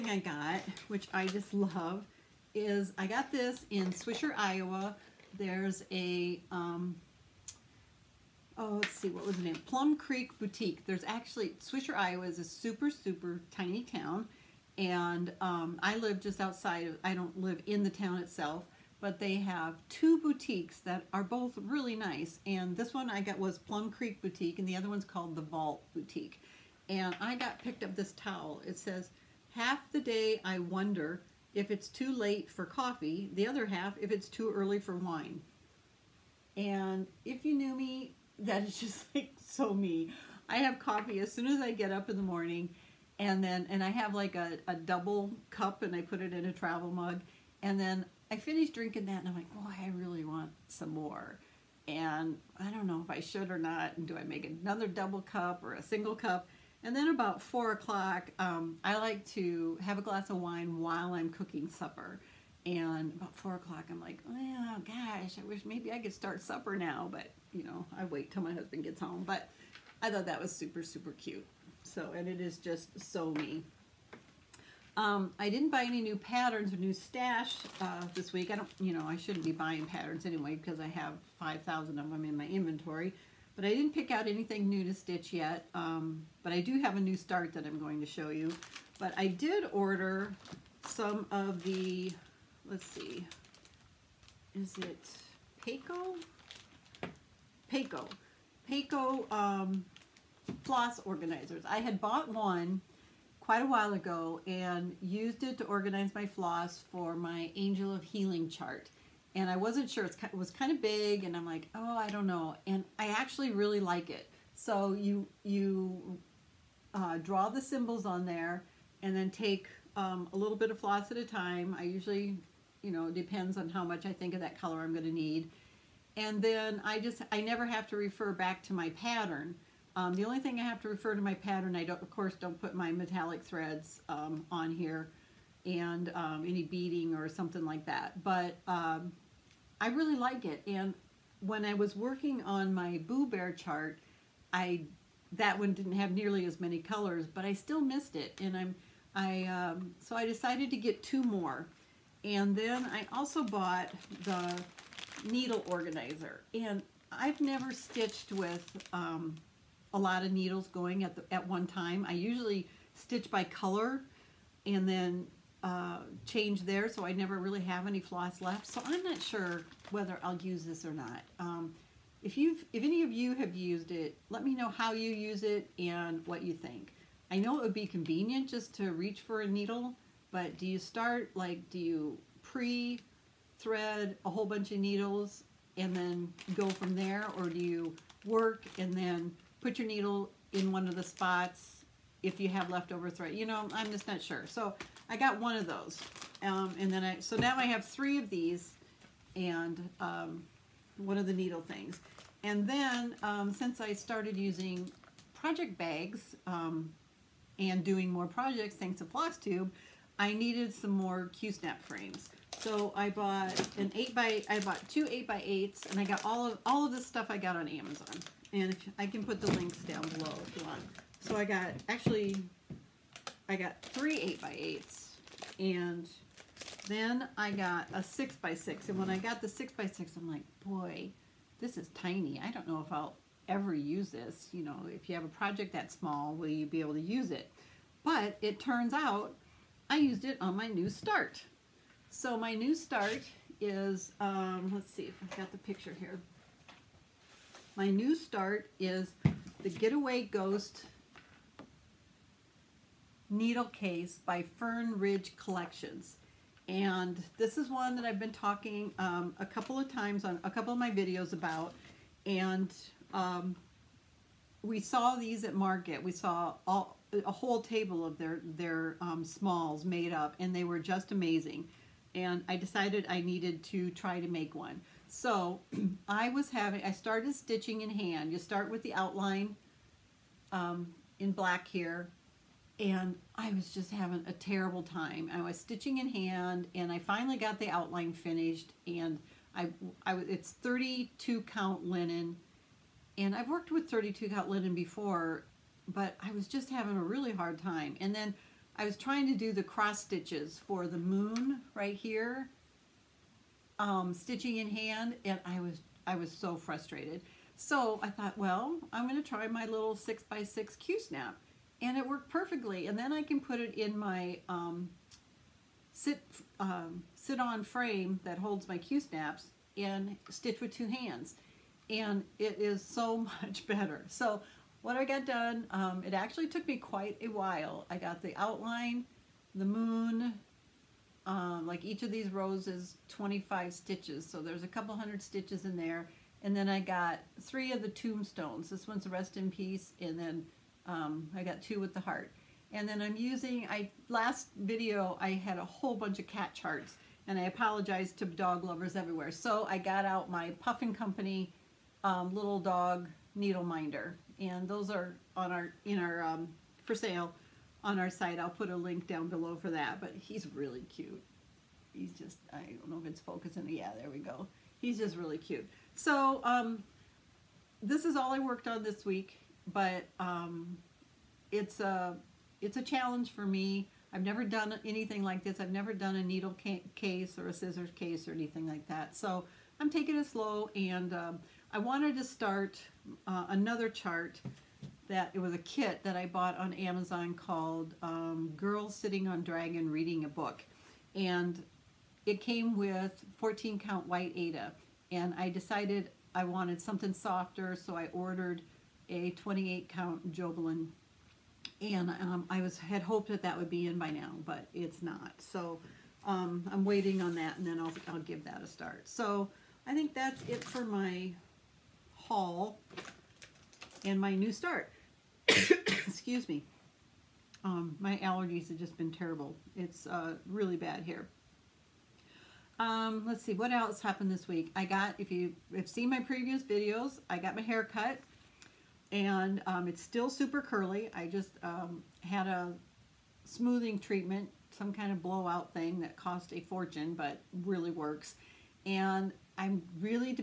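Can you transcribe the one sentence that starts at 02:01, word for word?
I usually, you know, depends on how much I think of that color I'm going to need.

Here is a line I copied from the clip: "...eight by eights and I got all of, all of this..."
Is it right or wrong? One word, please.
right.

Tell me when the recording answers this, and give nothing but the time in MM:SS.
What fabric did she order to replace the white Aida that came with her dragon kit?
06:39.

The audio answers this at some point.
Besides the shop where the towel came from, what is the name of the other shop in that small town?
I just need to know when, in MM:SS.
00:25.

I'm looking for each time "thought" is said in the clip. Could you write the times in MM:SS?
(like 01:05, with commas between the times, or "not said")
01:10, 05:08.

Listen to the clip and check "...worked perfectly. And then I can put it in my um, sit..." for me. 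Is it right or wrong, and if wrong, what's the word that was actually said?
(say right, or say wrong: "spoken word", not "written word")
right.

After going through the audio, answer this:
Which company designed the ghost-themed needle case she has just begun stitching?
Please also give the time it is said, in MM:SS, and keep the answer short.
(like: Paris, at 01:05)
Fern Ridge Collections, at 04:14.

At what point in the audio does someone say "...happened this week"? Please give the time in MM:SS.
07:04.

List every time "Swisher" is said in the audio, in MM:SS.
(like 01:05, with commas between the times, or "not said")
00:03, 00:11.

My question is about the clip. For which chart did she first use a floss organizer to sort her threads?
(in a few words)
Angel of Healing.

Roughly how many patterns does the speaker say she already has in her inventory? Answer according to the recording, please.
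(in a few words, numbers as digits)
5,000.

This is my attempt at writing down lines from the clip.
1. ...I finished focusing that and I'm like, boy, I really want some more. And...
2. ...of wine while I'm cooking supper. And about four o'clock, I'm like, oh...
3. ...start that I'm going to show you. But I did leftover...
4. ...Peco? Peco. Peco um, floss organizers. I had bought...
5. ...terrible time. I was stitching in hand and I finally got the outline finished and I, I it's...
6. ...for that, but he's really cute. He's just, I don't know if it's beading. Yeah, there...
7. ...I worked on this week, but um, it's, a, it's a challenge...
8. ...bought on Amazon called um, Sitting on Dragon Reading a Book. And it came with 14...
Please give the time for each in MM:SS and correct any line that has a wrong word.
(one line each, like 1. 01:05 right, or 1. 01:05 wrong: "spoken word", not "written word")
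1. 00:48 wrong: "drinking", not "focusing"
2. 01:00 right
3. 01:27 wrong: "order", not "leftover"
4. 01:35 right
5. 04:44 right
6. 05:59 wrong: "focusing", not "beading"
7. 06:08 right
8. 06:26 right.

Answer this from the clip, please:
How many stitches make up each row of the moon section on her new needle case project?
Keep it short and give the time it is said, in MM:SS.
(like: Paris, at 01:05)
25, at 05:33.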